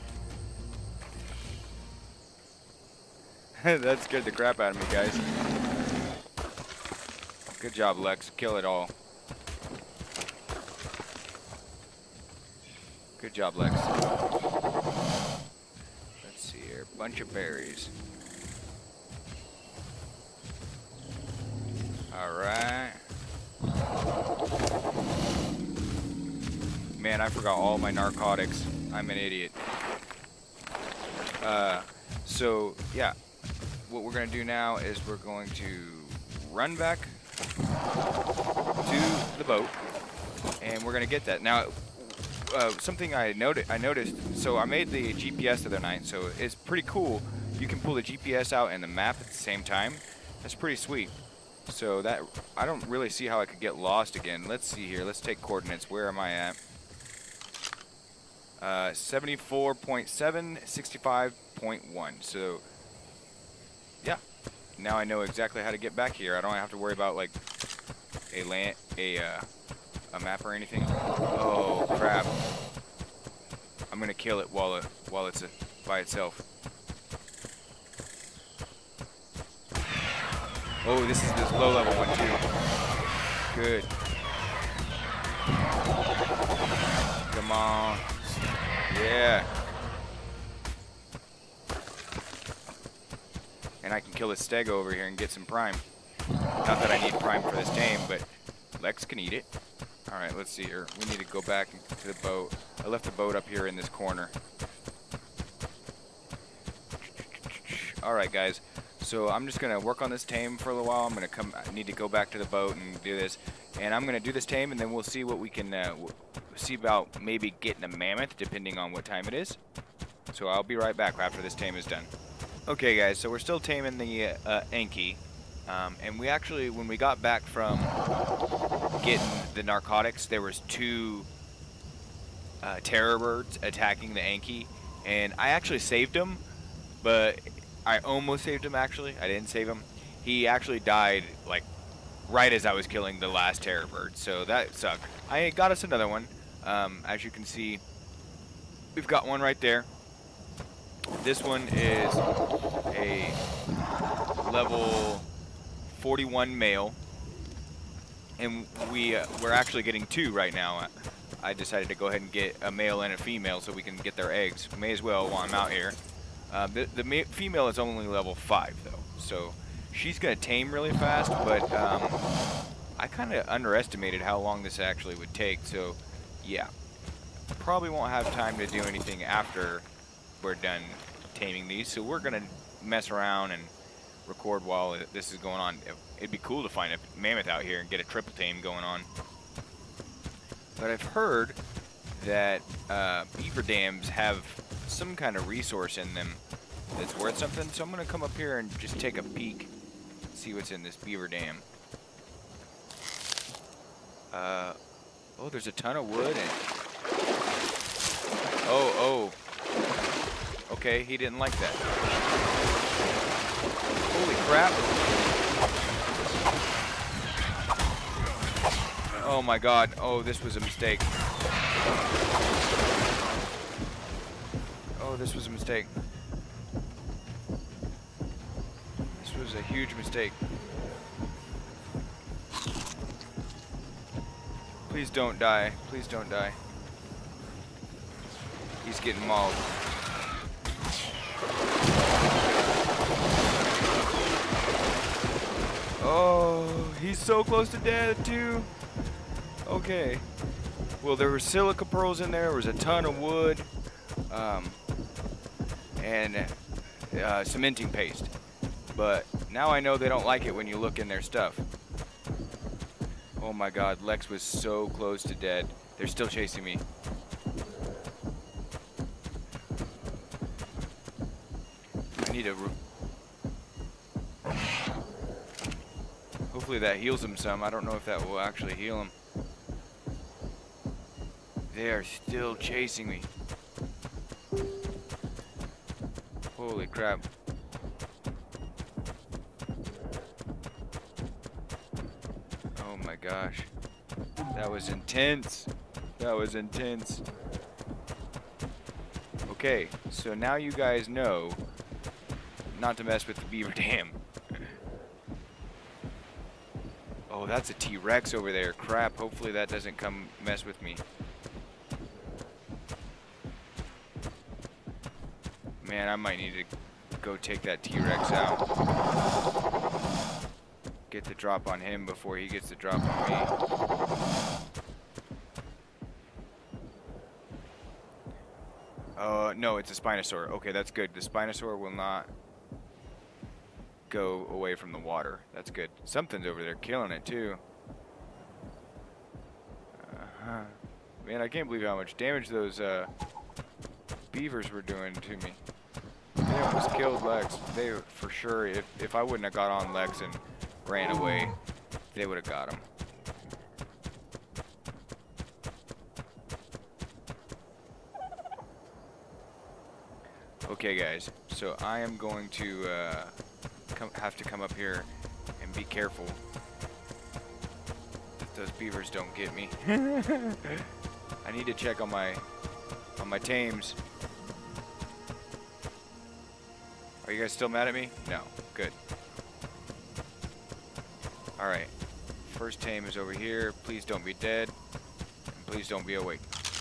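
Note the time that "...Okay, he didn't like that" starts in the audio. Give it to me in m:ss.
3:30.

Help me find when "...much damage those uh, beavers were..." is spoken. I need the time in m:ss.
5:41.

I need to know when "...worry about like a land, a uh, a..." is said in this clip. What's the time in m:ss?
1:06.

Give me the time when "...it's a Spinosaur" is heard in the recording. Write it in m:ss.
5:29.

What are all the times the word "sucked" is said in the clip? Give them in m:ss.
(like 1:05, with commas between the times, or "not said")
2:24.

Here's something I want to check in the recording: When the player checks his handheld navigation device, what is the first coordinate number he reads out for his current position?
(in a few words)
74.7.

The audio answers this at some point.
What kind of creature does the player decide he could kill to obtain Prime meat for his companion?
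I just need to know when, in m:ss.
1:34.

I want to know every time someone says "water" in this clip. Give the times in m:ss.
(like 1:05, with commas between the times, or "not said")
5:34.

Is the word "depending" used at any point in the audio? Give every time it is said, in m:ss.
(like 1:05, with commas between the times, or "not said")
1:58.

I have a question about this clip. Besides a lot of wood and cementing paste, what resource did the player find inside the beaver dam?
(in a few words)
silica pearls.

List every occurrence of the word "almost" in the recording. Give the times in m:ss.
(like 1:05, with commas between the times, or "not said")
2:17, 5:46.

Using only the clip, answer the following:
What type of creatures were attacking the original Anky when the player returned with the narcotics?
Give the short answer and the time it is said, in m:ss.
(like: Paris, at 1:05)
terror birds, at 2:12.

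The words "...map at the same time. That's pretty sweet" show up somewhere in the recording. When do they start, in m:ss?
0:48.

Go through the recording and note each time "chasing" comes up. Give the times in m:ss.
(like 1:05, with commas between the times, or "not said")
4:26, 4:42.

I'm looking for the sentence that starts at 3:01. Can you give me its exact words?
So we're gonna mess around and record while this is going on.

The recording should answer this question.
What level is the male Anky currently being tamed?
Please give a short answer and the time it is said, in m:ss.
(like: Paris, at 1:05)
41, at 2:35.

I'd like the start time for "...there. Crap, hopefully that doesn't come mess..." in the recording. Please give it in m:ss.
5:08.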